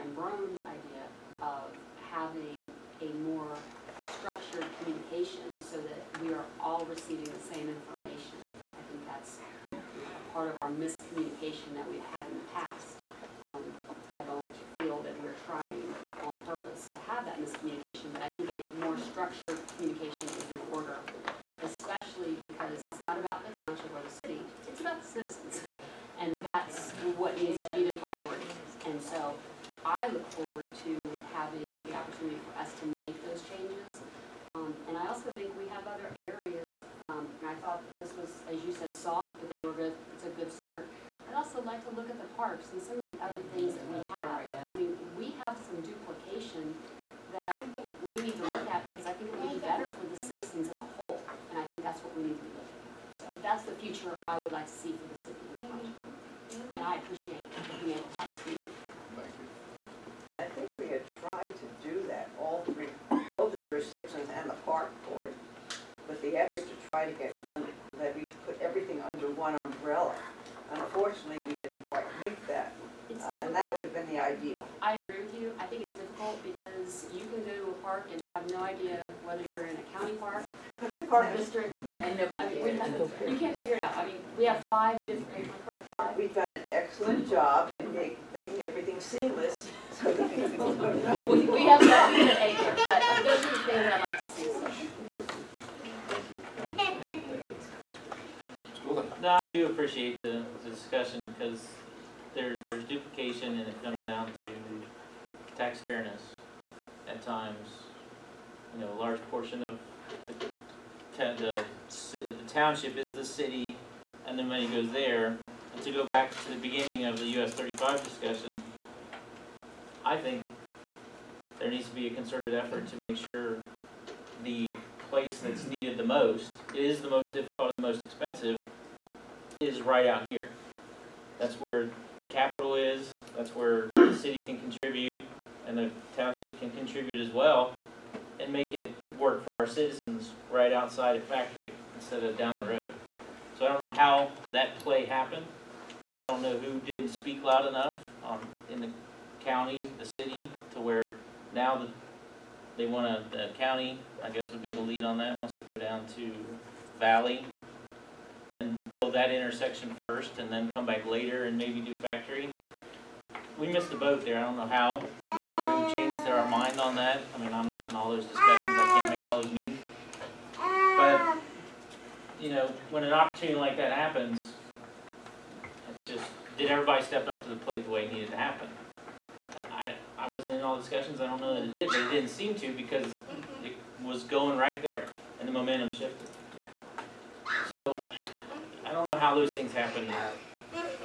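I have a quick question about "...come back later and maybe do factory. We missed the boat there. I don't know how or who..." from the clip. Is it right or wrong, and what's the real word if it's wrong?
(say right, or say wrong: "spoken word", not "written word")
right.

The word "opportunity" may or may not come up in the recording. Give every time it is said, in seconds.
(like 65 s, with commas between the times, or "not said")
31 s, 173 s.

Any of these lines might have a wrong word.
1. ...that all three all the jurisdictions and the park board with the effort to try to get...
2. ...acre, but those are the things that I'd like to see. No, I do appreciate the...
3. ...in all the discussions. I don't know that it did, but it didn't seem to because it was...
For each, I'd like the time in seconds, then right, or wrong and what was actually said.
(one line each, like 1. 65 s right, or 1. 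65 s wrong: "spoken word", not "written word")
1. 62 s right
2. 92 s right
3. 180 s right.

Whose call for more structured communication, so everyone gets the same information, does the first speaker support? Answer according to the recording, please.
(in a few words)
Brown.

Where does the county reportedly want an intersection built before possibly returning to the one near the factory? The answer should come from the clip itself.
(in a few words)
Valley.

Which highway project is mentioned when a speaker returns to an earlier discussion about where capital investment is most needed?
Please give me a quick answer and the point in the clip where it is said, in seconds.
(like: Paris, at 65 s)
US 35, at 117 s.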